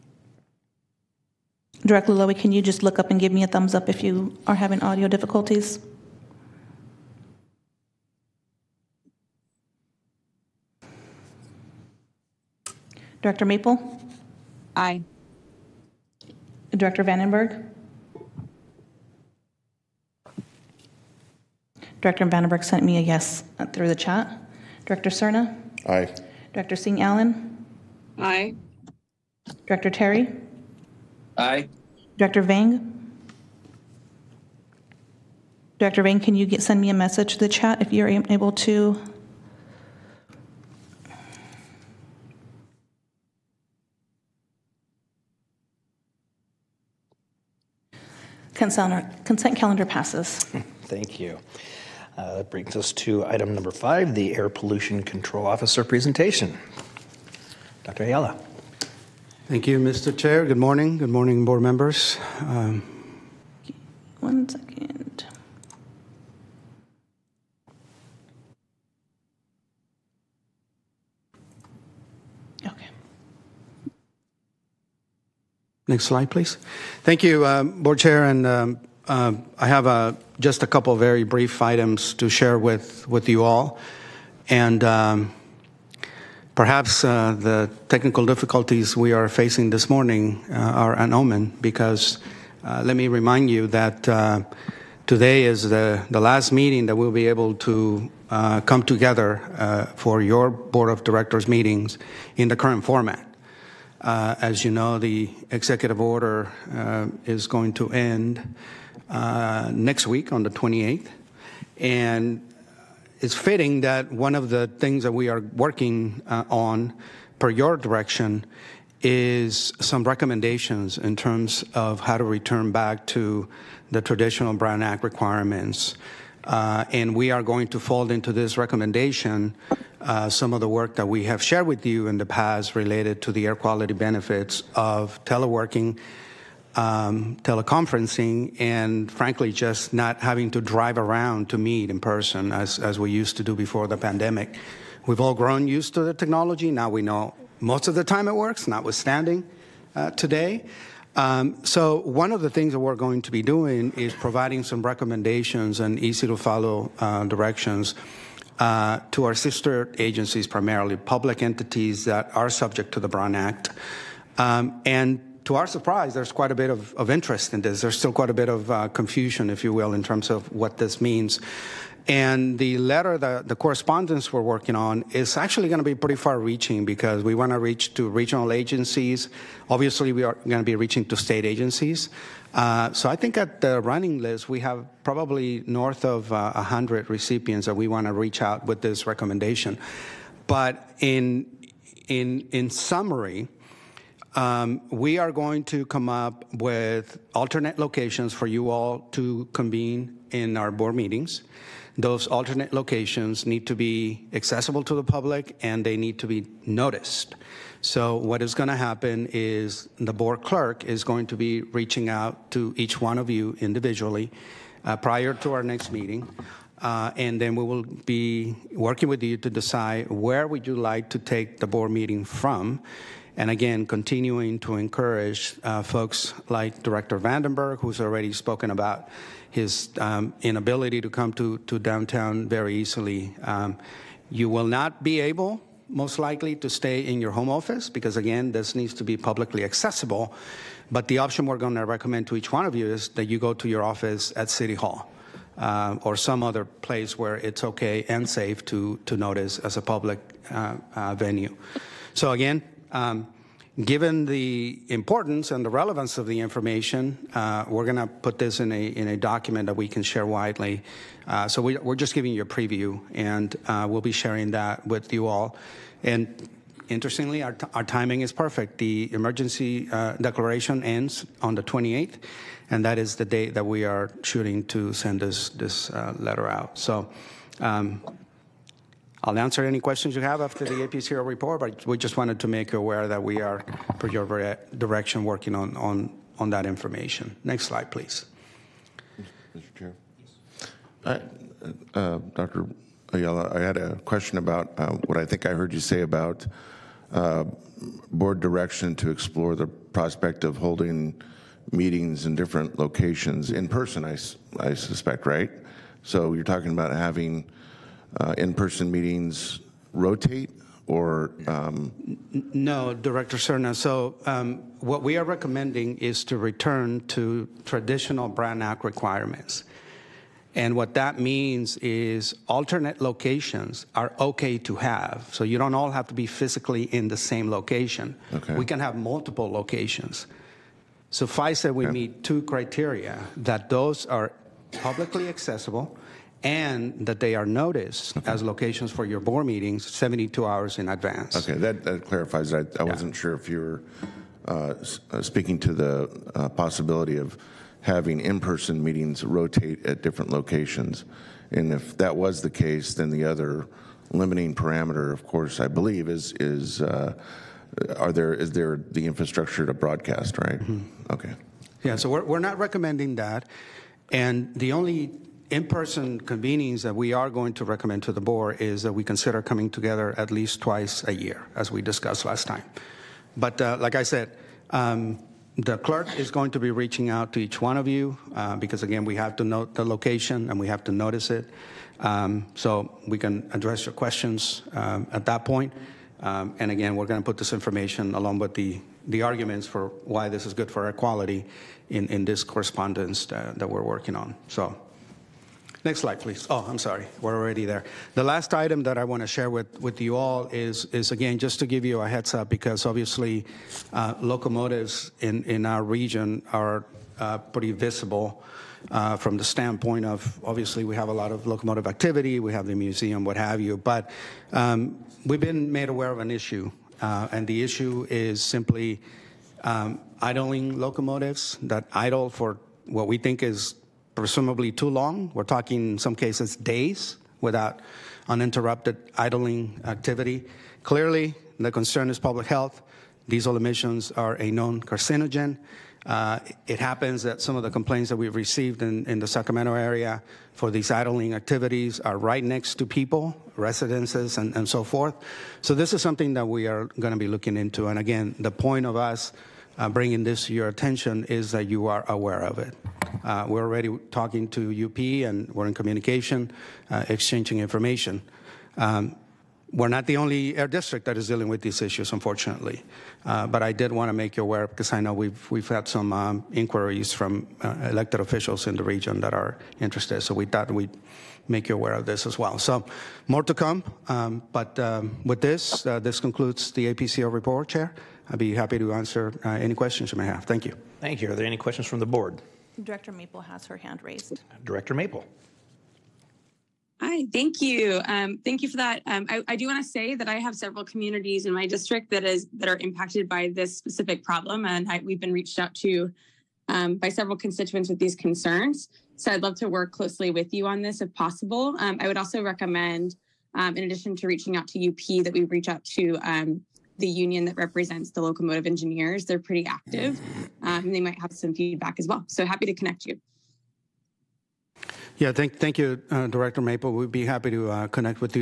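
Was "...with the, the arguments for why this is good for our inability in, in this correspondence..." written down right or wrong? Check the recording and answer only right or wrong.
wrong.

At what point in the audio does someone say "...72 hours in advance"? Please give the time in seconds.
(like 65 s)
339 s.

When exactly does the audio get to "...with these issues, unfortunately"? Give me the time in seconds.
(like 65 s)
461 s.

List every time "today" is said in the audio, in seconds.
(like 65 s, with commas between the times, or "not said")
95 s, 150 s.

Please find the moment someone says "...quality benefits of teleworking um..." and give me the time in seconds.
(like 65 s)
133 s.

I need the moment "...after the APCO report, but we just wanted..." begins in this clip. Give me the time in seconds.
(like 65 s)
280 s.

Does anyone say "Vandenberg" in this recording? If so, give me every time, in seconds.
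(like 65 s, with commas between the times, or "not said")
17 s, 22 s, 227 s.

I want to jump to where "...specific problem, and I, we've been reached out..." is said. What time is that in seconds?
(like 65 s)
493 s.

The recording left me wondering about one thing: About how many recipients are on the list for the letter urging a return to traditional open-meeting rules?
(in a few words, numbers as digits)
north of 100.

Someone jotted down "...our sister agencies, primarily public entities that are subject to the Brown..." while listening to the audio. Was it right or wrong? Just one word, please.
right.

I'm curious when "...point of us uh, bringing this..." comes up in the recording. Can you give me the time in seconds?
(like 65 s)
448 s.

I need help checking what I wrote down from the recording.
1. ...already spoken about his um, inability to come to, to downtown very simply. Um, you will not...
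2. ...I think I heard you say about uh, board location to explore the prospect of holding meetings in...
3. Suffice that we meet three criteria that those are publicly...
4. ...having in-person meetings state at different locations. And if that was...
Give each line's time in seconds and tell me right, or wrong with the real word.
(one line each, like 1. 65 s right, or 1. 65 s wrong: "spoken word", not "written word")
1. 228 s wrong: "easily", not "simply"
2. 295 s wrong: "direction", not "location"
3. 331 s wrong: "two", not "three"
4. 347 s wrong: "rotate", not "state".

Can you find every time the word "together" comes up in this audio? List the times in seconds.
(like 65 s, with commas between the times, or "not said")
98 s, 369 s.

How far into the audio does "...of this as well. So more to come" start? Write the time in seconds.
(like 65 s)
471 s.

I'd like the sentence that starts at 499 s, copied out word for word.
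So I'd love to work closely with you on this if possible.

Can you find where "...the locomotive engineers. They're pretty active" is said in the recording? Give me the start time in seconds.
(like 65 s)
508 s.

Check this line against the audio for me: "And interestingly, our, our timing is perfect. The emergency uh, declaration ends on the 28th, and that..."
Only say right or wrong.
right.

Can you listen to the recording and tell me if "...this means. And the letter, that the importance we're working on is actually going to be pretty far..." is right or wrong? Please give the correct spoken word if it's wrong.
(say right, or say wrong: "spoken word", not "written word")
wrong: "correspondence", not "importance".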